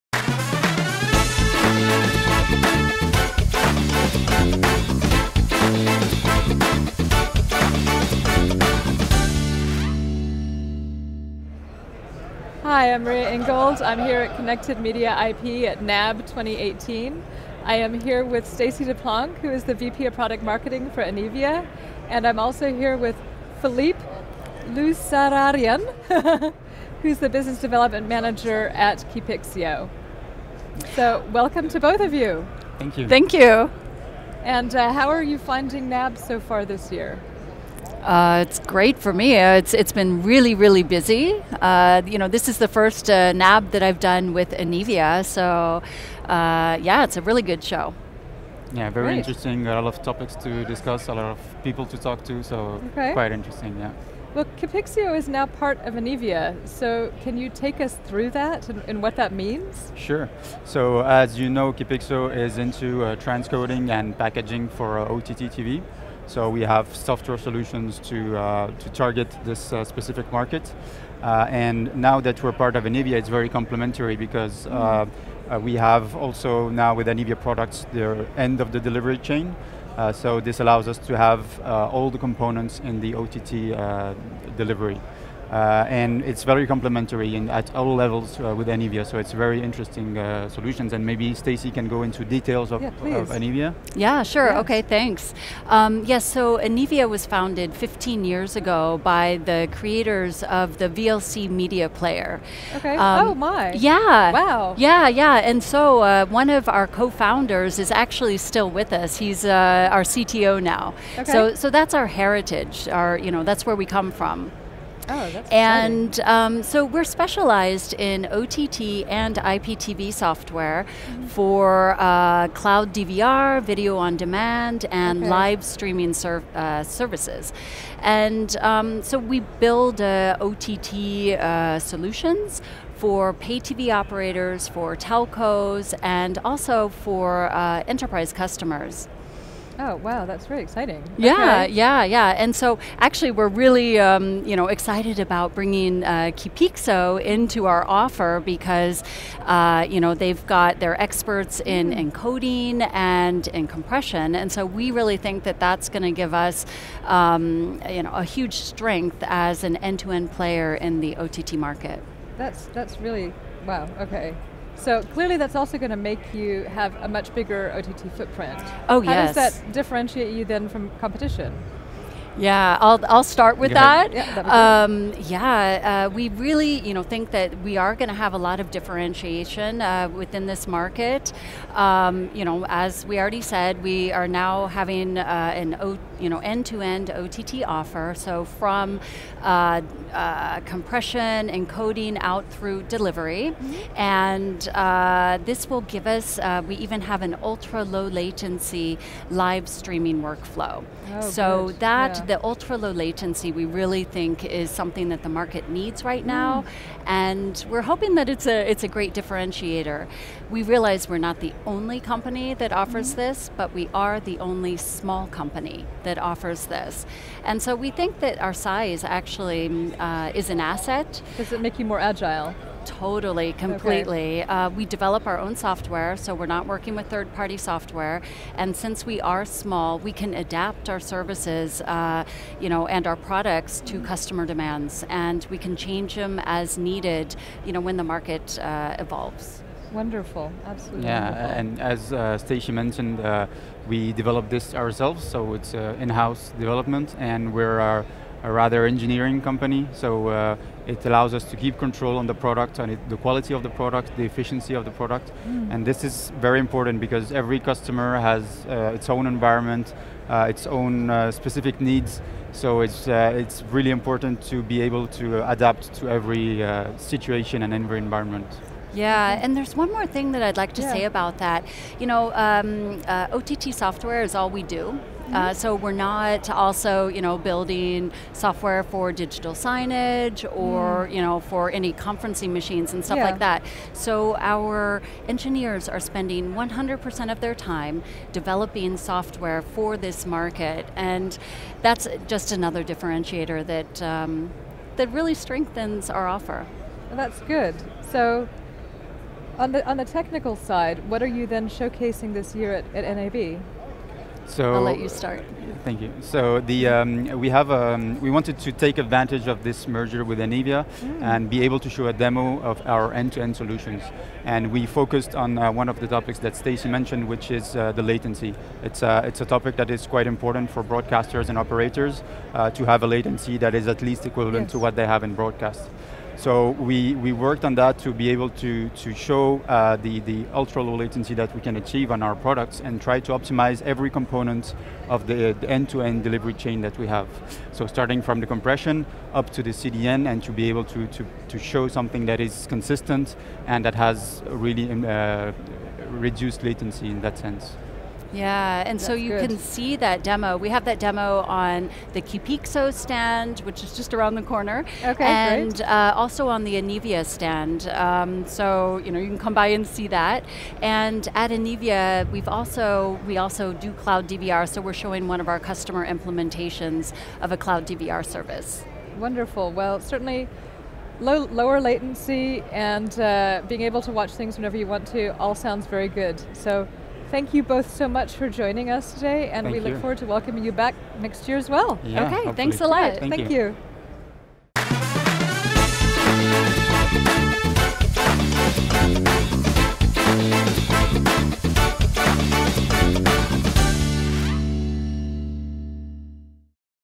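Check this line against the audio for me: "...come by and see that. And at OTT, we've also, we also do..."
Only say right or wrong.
wrong.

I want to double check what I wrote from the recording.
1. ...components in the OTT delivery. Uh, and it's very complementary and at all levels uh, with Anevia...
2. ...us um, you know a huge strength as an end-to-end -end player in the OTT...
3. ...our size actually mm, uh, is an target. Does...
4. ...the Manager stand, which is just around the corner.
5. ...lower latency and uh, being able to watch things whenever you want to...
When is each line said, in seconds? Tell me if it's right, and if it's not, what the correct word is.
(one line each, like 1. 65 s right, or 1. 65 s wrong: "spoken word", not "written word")
1. 82 s right
2. 156 s right
3. 218 s wrong: "asset", not "target"
4. 352 s wrong: "Keepixo", not "Manager"
5. 371 s right.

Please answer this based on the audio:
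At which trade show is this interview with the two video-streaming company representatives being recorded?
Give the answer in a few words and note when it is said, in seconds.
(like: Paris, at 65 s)
NAB 2018, at 15 s.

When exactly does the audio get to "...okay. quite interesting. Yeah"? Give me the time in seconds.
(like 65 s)
52 s.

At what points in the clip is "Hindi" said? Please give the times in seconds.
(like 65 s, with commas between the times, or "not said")
not said.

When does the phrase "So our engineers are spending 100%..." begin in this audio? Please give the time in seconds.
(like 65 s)
283 s.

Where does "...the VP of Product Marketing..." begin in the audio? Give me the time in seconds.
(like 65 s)
19 s.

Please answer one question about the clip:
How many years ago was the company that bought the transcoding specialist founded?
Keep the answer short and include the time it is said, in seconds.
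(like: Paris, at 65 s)
15, at 97 s.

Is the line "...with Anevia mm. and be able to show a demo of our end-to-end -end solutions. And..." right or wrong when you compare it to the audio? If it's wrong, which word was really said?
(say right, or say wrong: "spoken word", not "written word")
right.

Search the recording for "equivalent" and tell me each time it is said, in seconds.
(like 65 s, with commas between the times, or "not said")
324 s.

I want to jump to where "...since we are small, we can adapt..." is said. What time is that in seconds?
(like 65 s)
228 s.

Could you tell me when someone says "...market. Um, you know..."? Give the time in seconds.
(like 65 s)
180 s.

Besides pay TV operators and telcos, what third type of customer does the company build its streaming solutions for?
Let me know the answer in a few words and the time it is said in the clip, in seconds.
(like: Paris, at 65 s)
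enterprise customers, at 137 s.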